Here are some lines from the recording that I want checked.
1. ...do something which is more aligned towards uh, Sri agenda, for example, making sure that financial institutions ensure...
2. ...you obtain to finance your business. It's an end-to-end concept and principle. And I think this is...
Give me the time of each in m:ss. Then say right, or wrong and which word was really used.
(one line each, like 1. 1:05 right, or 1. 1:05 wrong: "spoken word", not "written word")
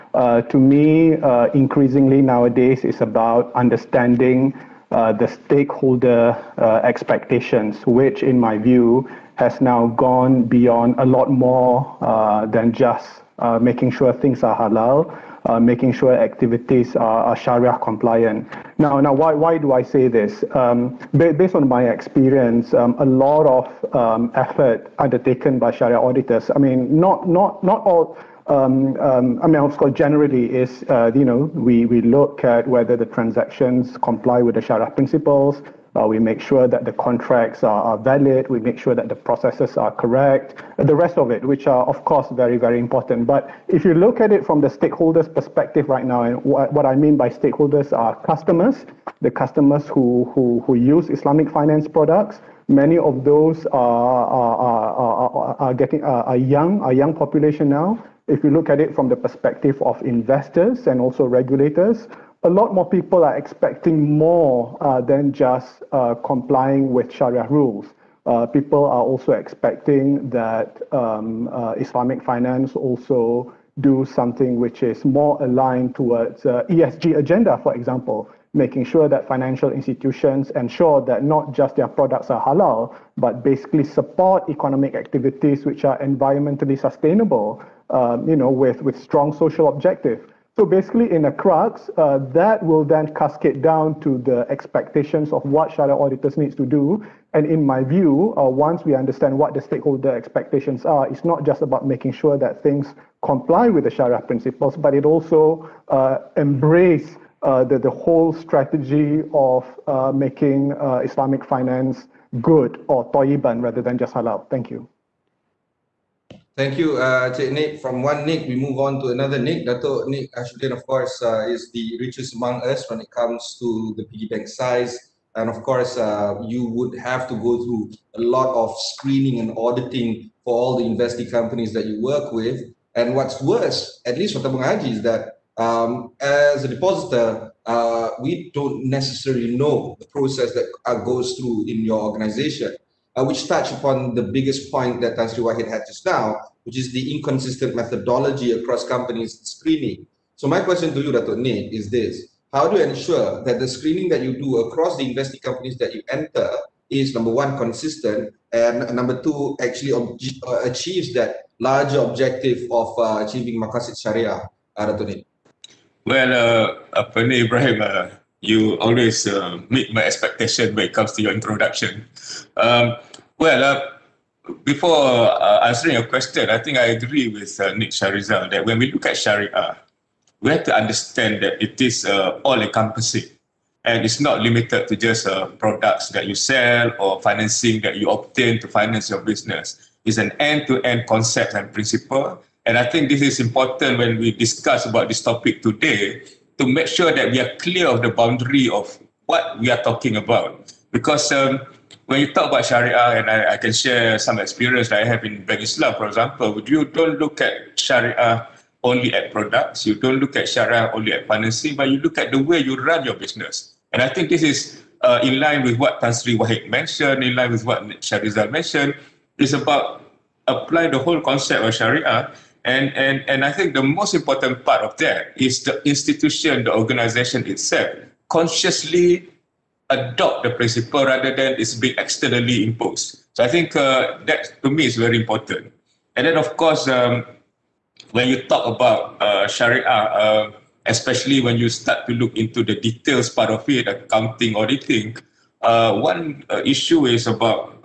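1. 1:13 wrong: "ESG", not "Sri"
2. 3:07 right.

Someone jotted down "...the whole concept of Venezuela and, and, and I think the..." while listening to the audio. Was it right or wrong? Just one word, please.
wrong.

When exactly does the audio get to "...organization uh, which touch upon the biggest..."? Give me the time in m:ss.
2:22.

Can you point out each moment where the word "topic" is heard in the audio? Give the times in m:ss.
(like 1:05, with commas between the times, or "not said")
3:15.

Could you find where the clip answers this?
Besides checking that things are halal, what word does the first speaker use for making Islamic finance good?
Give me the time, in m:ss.
1:53.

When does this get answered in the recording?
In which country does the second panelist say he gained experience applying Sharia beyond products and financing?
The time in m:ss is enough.
3:25.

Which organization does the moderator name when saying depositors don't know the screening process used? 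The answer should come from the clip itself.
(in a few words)
Tabung Haji.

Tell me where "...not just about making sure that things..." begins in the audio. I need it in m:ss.
1:41.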